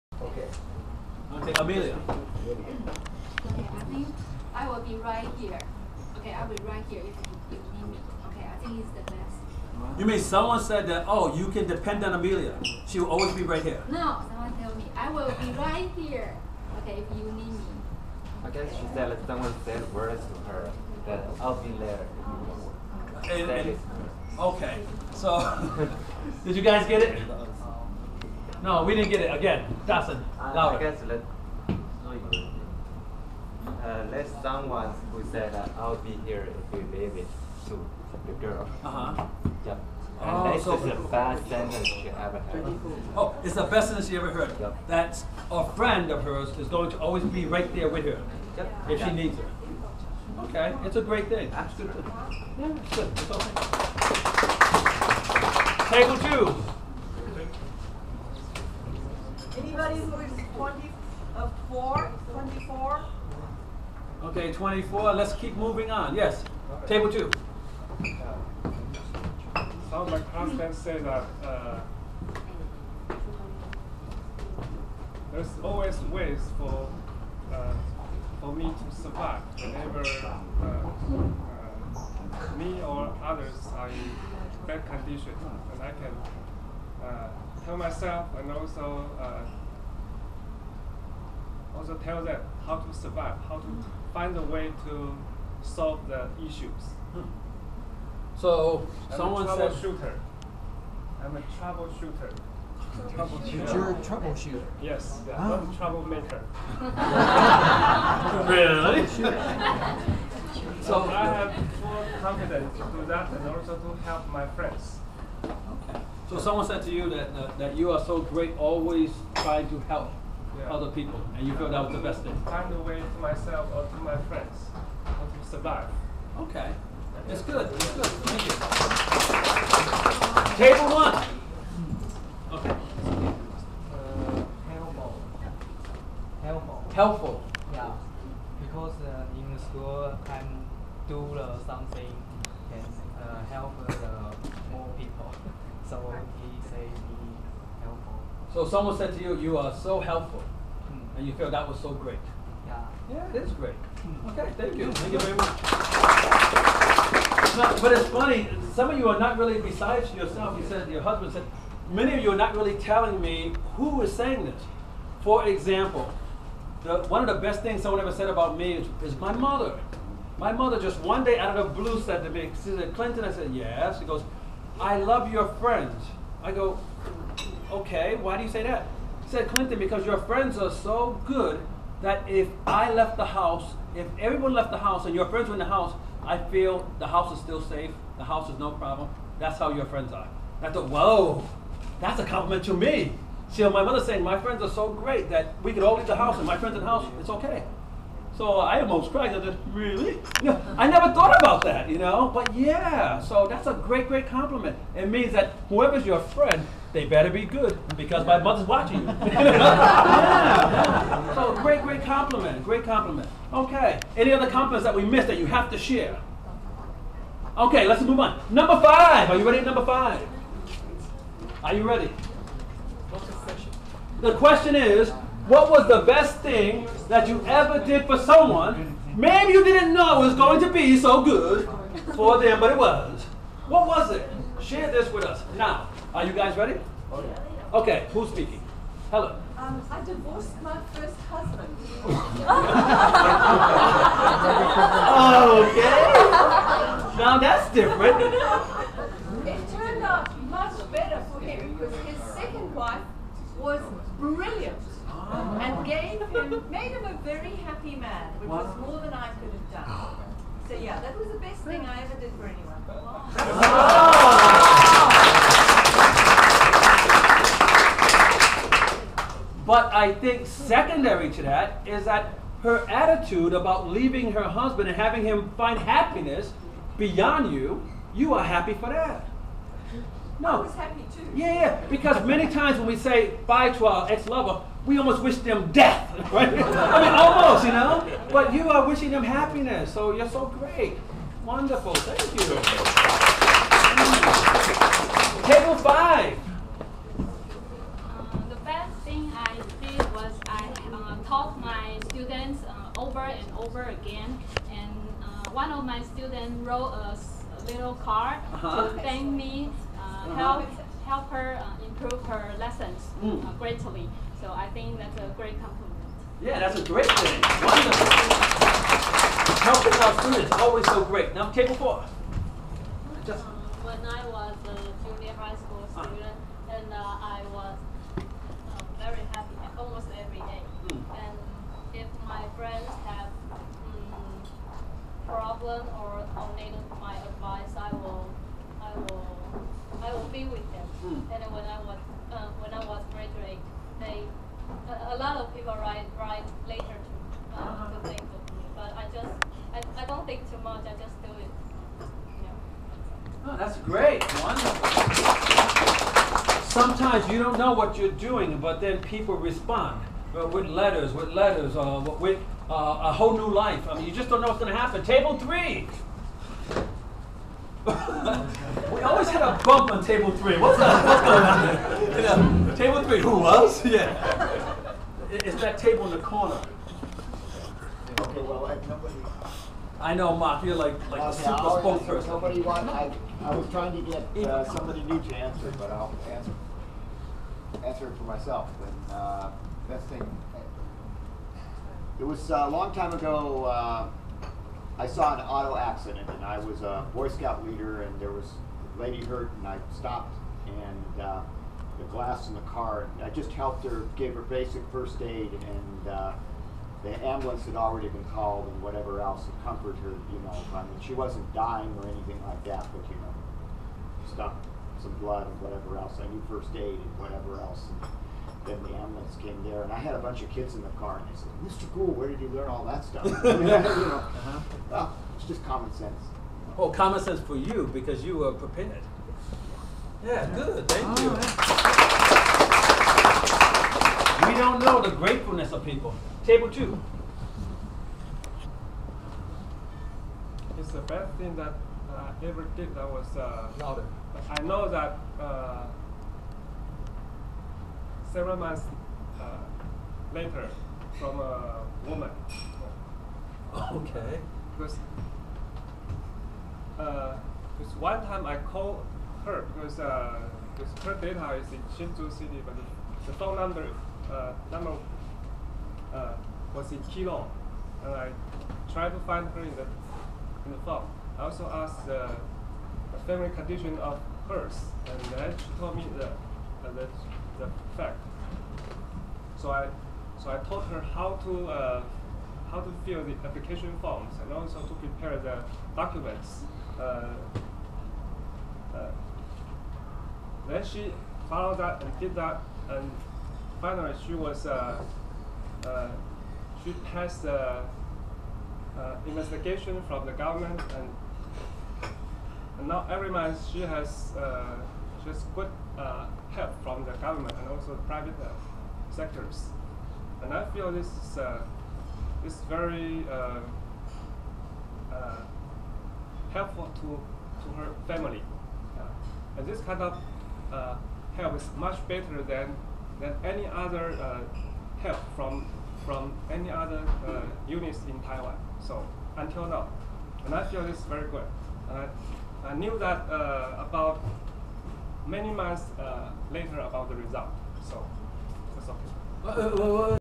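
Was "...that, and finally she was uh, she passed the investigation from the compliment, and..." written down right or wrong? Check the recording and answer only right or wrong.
wrong.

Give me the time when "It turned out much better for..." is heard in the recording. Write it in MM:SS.
04:09.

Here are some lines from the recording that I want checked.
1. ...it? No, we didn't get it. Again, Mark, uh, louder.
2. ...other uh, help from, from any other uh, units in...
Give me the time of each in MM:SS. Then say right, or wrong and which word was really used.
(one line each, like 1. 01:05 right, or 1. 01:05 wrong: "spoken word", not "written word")
1. 00:27 wrong: "Dustin", not "Mark"
2. 08:43 right.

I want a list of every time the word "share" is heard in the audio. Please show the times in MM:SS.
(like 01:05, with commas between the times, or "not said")
03:35, 03:54.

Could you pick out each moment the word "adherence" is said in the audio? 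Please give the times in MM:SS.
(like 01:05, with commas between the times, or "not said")
not said.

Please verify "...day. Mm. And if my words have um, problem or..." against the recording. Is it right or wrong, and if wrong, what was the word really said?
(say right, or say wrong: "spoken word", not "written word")
wrong: "friends", not "words".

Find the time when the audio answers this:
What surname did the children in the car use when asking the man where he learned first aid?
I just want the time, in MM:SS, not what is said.
07:01.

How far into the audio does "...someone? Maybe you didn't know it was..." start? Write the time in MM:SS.
03:48.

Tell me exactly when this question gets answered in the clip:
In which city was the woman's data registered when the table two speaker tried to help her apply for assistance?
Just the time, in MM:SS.
07:41.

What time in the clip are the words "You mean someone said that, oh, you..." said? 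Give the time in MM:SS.
00:09.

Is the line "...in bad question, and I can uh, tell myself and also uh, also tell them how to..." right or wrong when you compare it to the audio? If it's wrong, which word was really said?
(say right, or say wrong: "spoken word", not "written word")
wrong: "condition", not "question".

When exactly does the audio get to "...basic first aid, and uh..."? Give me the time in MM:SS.
06:44.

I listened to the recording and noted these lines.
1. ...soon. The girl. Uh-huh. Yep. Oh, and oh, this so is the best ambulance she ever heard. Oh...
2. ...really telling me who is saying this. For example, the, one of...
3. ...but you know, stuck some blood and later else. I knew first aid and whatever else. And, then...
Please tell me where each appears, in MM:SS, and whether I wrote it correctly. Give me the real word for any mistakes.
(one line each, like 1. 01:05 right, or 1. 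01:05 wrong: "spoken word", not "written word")
1. 00:37 wrong: "sentence", not "ambulance"
2. 02:42 right
3. 06:52 wrong: "whatever", not "later".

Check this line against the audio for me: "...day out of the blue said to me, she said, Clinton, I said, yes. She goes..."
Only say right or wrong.
right.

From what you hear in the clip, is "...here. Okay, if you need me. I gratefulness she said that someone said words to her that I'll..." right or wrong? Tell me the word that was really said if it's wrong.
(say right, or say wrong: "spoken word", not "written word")
wrong: "guess", not "gratefulness".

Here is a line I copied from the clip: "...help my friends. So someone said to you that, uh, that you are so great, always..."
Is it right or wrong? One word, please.
right.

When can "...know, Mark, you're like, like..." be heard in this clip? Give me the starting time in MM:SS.
06:20.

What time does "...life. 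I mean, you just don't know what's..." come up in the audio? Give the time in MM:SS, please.
06:03.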